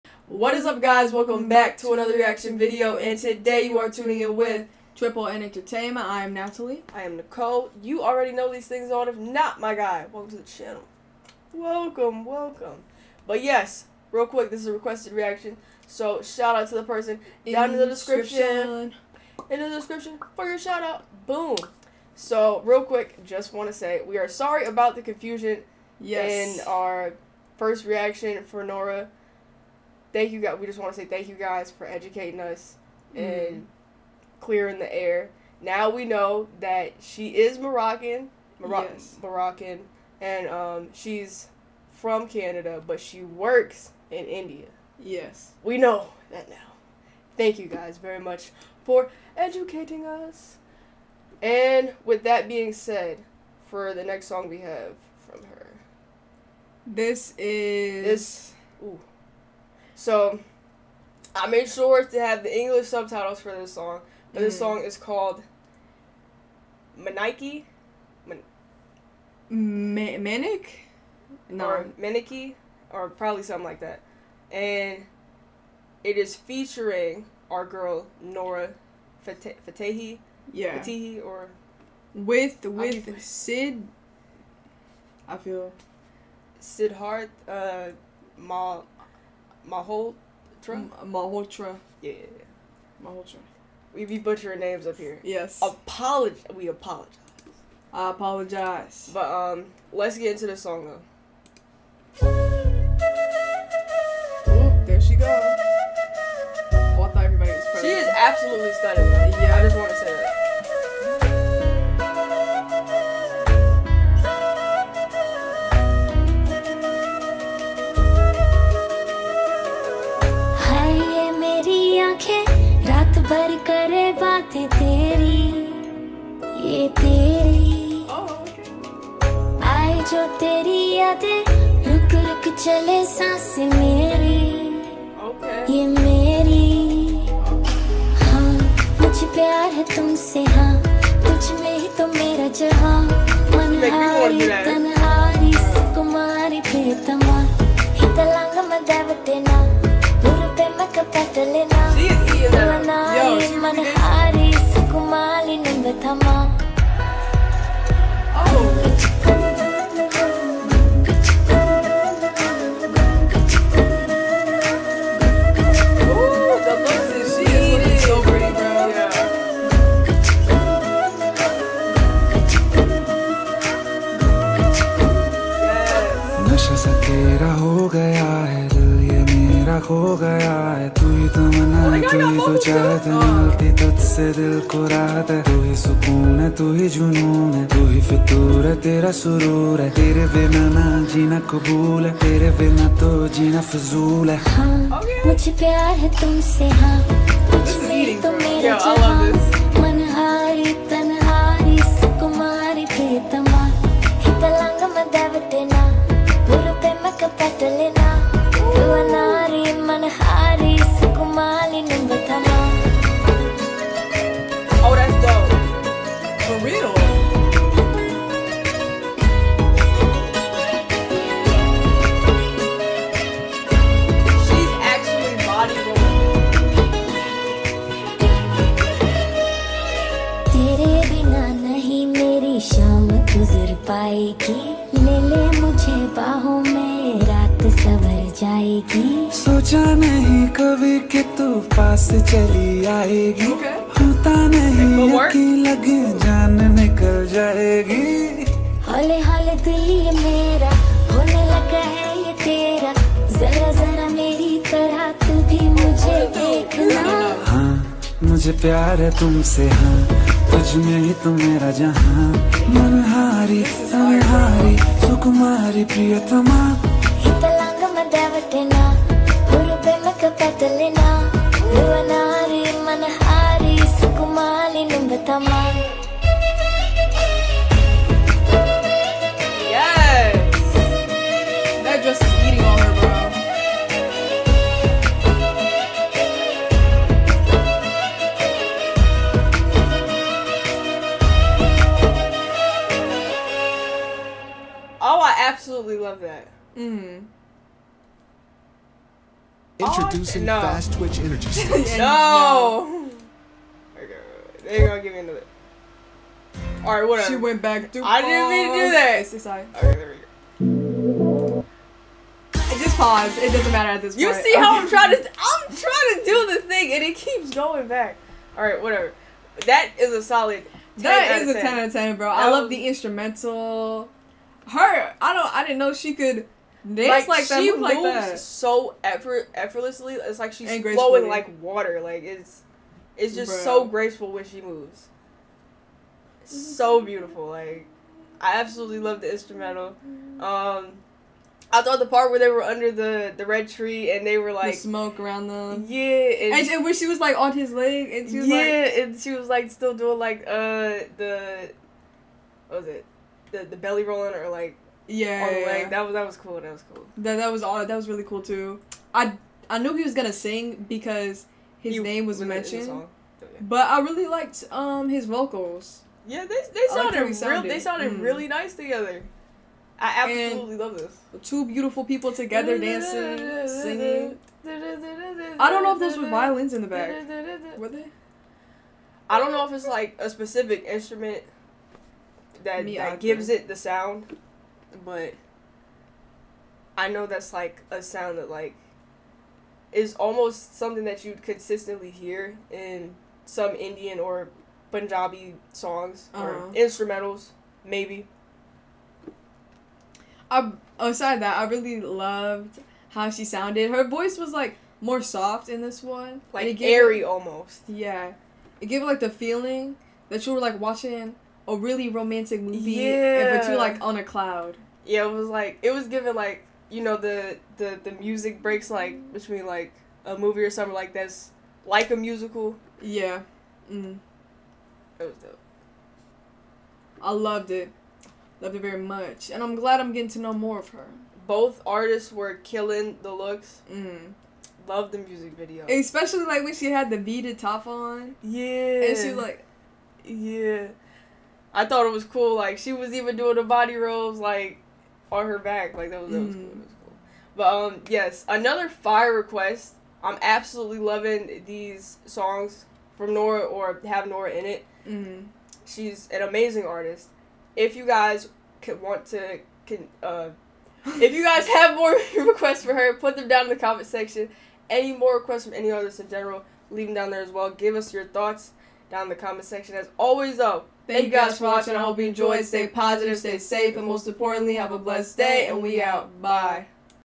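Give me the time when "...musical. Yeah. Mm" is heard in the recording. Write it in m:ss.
7:02.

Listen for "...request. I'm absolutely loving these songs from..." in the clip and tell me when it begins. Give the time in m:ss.
7:29.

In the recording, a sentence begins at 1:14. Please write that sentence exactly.
And it is featuring our girl Nora Fatehi.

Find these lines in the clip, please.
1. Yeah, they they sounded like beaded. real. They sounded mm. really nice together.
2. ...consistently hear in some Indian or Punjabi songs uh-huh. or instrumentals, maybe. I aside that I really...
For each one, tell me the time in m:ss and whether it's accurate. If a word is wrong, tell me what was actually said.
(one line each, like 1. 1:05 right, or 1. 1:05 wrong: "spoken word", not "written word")
1. 6:06 wrong: "sounded", not "beaded"
2. 6:31 right.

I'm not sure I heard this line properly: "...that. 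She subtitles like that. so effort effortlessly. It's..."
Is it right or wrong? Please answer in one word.
wrong.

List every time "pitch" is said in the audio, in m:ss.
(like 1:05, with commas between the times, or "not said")
not said.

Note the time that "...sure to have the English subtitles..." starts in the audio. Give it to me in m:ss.
1:01.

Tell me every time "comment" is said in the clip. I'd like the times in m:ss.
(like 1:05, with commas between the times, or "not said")
7:43, 7:49.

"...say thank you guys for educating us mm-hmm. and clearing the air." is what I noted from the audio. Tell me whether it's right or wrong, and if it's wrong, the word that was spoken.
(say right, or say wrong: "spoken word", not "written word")
right.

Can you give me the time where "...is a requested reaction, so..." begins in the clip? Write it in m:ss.
0:14.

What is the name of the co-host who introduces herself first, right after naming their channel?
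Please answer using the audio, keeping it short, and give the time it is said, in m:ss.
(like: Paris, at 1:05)
Natalie, at 0:06.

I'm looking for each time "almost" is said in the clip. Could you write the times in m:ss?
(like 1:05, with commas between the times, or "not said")
6:30, 6:47.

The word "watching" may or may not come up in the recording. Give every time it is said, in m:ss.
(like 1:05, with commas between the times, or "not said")
6:50, 7:51.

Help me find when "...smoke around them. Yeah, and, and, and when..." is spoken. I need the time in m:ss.
5:44.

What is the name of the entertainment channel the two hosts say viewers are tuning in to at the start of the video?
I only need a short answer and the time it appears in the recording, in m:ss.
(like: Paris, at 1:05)
Triple N Entertainment, at 0:04.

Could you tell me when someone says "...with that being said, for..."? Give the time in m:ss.
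0:52.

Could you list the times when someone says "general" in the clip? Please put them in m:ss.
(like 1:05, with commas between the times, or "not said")
7:46.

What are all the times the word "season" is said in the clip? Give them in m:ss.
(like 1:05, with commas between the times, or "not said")
not said.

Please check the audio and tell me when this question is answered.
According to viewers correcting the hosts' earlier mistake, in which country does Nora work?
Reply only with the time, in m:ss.
0:44.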